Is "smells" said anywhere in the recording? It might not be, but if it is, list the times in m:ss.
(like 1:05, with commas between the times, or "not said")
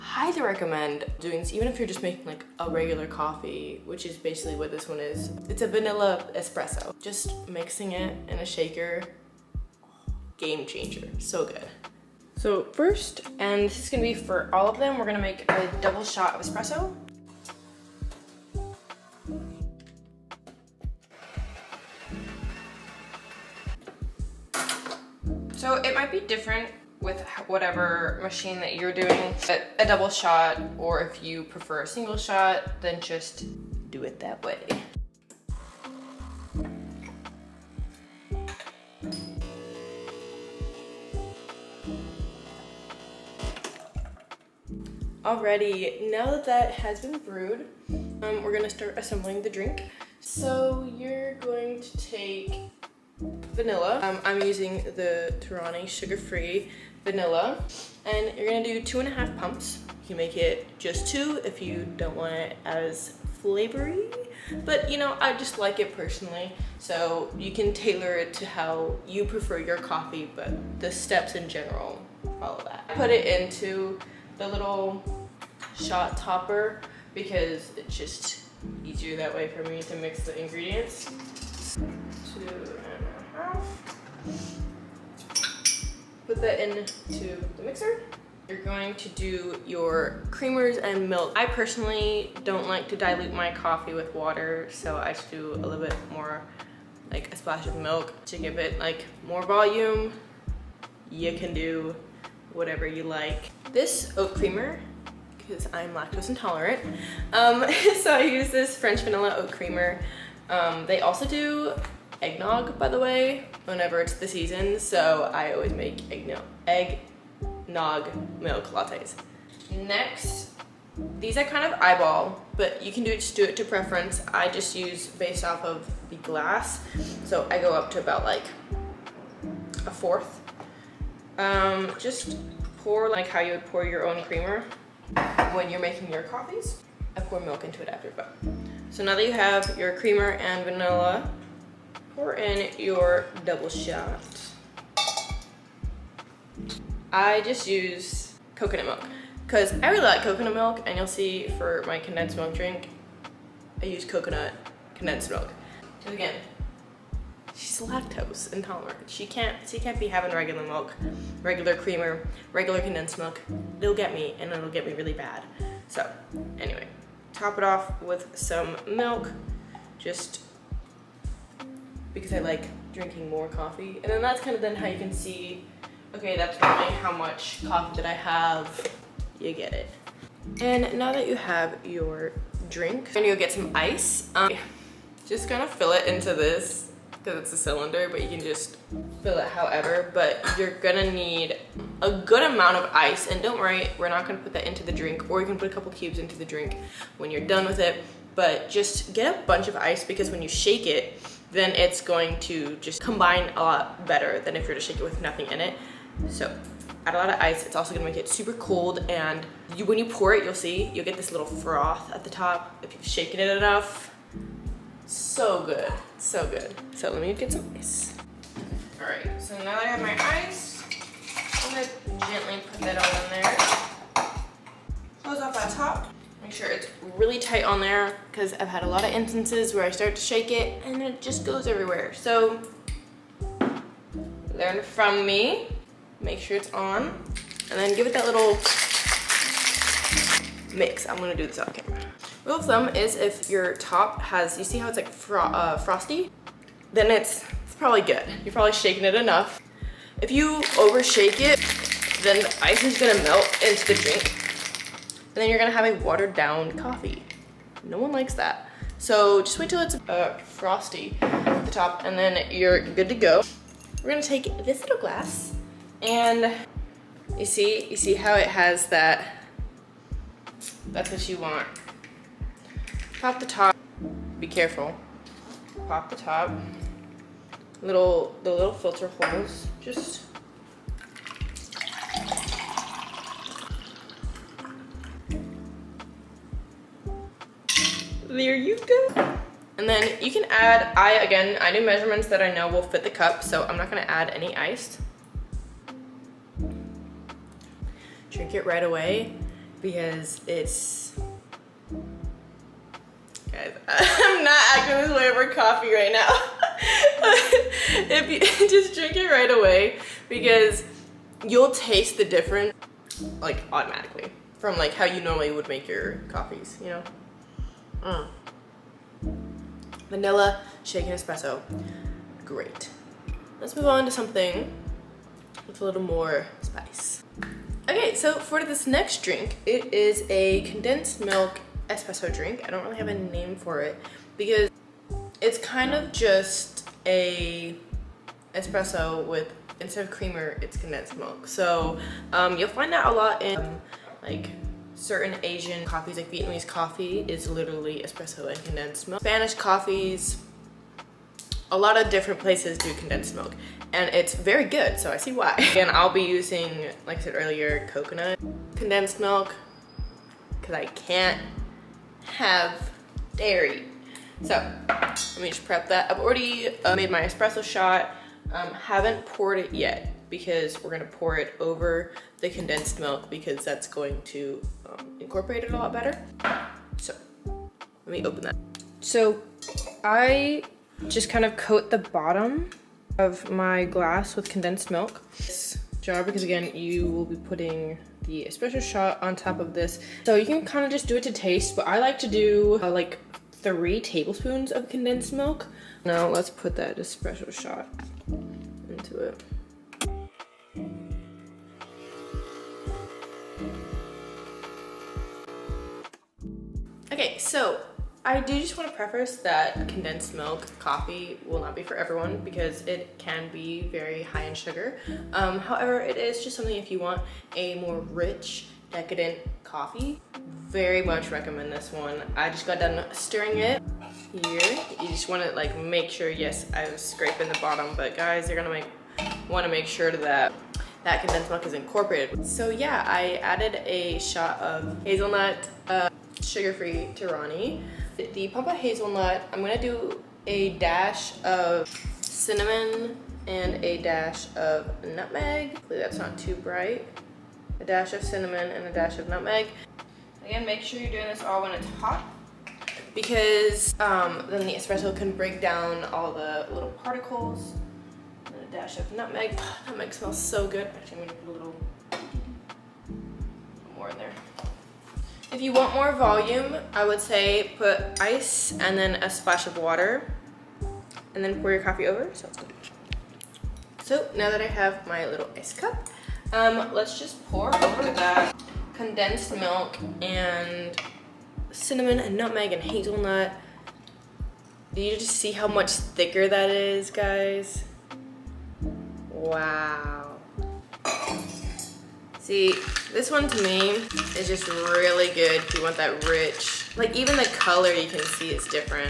7:40.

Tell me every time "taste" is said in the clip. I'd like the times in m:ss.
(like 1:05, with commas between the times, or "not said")
5:11, 6:31.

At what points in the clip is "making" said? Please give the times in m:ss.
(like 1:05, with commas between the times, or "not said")
0:02, 2:15.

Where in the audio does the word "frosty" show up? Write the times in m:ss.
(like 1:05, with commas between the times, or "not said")
4:05, 4:20.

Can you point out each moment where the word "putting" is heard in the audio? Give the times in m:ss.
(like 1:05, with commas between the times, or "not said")
6:27.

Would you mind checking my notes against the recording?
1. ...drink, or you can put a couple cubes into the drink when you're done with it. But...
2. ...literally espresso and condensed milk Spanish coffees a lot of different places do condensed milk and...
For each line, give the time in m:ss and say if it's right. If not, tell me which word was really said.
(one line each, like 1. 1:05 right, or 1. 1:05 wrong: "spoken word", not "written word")
1. 3:14 right
2. 5:47 right.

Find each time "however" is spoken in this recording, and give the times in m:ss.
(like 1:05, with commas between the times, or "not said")
3:09, 6:55.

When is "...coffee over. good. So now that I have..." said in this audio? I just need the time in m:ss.
7:51.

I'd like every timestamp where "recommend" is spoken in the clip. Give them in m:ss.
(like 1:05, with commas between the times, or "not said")
0:00, 7:01.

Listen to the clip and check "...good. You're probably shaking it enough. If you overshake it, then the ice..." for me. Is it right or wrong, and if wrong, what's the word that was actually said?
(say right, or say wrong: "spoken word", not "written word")
right.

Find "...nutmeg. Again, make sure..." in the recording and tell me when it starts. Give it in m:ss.
7:29.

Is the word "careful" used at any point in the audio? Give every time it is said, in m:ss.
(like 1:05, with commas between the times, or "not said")
4:34.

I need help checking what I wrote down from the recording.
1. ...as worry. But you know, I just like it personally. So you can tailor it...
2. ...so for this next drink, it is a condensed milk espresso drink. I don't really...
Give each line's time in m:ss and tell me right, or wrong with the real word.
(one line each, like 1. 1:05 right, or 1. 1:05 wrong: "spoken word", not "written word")
1. 1:02 wrong: "flavory", not "worry"
2. 5:28 right.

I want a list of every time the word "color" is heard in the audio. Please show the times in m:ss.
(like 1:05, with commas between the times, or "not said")
8:17.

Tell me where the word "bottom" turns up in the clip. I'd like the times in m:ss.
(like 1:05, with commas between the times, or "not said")
6:21, 7:07.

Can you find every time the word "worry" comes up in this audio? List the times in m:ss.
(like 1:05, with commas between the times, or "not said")
3:13.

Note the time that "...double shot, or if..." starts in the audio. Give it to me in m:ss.
0:29.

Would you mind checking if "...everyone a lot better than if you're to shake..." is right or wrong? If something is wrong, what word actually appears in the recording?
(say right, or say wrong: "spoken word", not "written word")
wrong: "combine", not "everyone".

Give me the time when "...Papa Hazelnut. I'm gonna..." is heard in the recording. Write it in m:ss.
7:18.